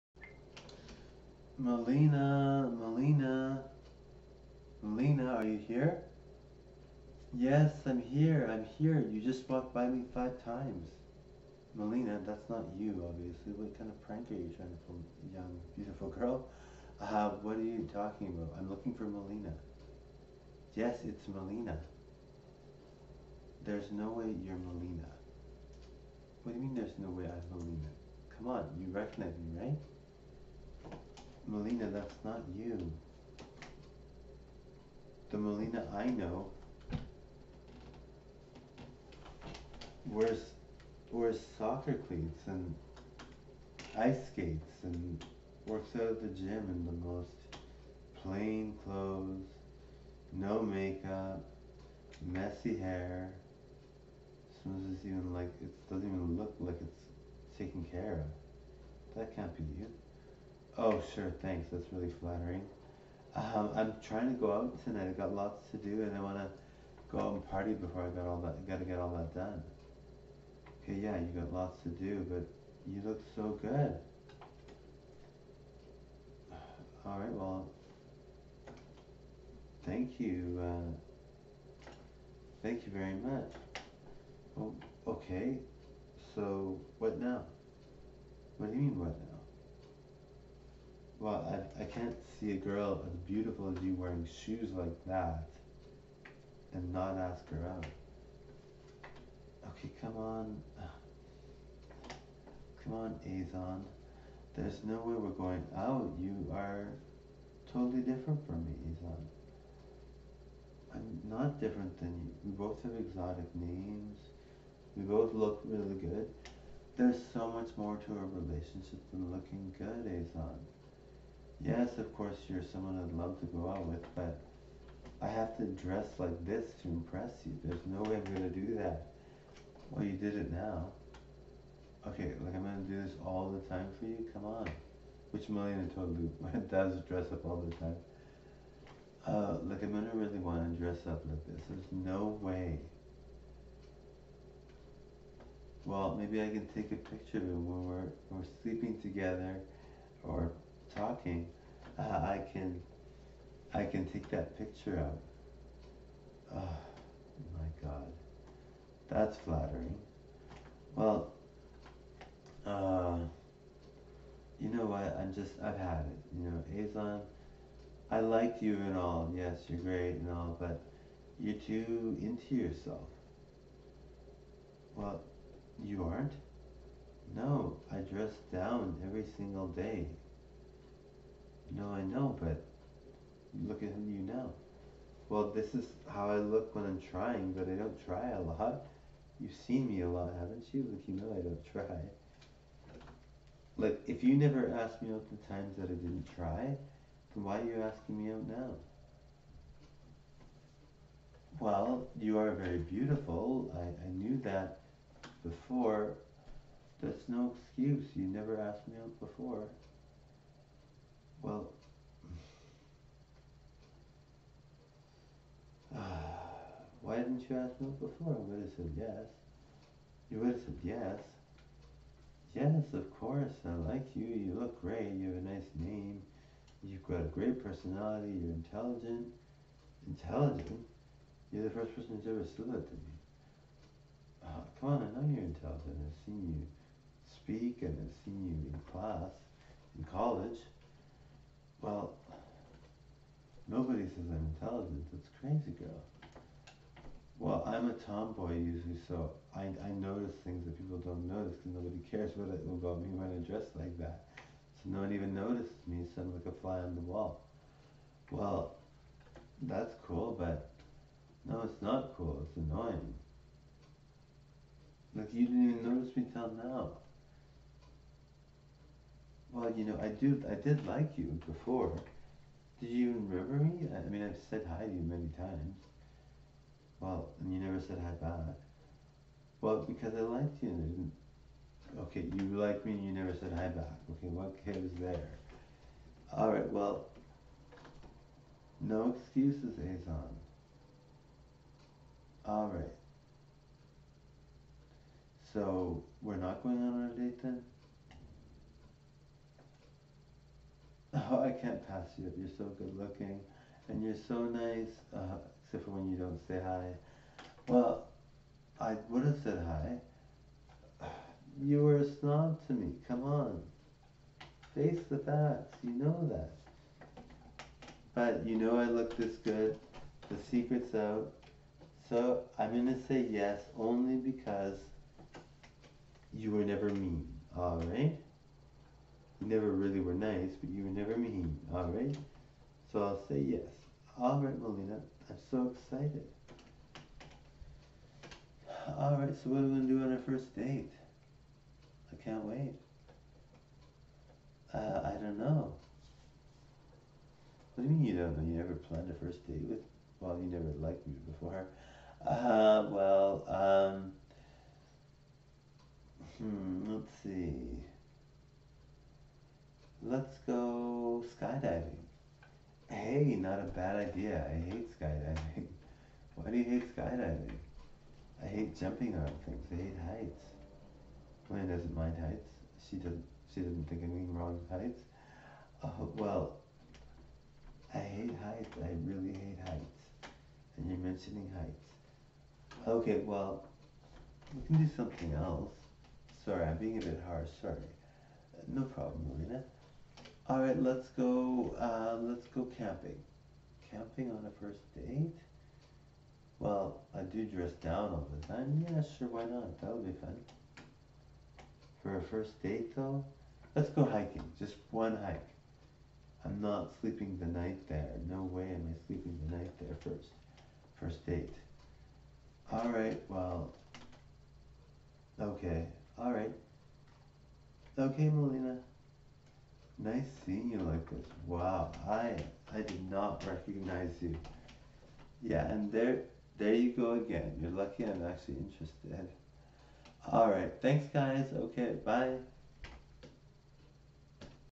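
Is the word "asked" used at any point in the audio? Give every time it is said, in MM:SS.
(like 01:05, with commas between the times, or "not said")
03:14, 03:28.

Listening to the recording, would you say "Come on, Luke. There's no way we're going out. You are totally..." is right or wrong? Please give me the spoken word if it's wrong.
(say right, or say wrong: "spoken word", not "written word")
wrong: "Azon", not "Luke".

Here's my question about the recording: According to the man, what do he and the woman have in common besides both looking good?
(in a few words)
exotic names.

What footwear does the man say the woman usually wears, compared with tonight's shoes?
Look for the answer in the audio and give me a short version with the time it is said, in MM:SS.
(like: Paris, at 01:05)
soccer cleats and ice skates, at 00:41.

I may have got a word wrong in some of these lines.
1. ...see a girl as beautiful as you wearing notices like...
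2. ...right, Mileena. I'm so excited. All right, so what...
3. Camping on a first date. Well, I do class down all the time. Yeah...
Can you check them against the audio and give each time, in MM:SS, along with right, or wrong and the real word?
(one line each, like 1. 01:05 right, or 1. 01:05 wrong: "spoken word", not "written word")
1. 01:32 wrong: "shoes", not "notices"
2. 05:34 right
3. 06:33 wrong: "dress", not "class".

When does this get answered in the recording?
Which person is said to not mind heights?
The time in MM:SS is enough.
06:11.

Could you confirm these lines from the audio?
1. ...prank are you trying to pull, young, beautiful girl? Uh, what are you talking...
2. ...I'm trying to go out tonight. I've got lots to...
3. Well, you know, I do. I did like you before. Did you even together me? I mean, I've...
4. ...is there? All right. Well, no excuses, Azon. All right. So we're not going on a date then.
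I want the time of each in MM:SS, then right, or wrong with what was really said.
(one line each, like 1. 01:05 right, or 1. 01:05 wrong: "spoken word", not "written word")
1. 00:14 right
2. 01:03 right
3. 04:29 wrong: "remember", not "together"
4. 04:44 right.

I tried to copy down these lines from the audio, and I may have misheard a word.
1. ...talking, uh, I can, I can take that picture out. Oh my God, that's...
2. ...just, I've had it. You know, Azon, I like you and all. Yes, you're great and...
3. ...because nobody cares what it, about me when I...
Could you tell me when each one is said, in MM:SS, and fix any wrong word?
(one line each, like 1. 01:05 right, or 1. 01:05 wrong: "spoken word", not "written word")
1. 02:30 right
2. 02:45 right
3. 04:11 right.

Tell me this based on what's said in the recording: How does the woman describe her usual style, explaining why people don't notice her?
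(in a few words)
tomboy.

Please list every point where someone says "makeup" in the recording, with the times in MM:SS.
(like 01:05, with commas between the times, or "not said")
00:50.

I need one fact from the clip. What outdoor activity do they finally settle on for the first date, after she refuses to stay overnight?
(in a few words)
hiking.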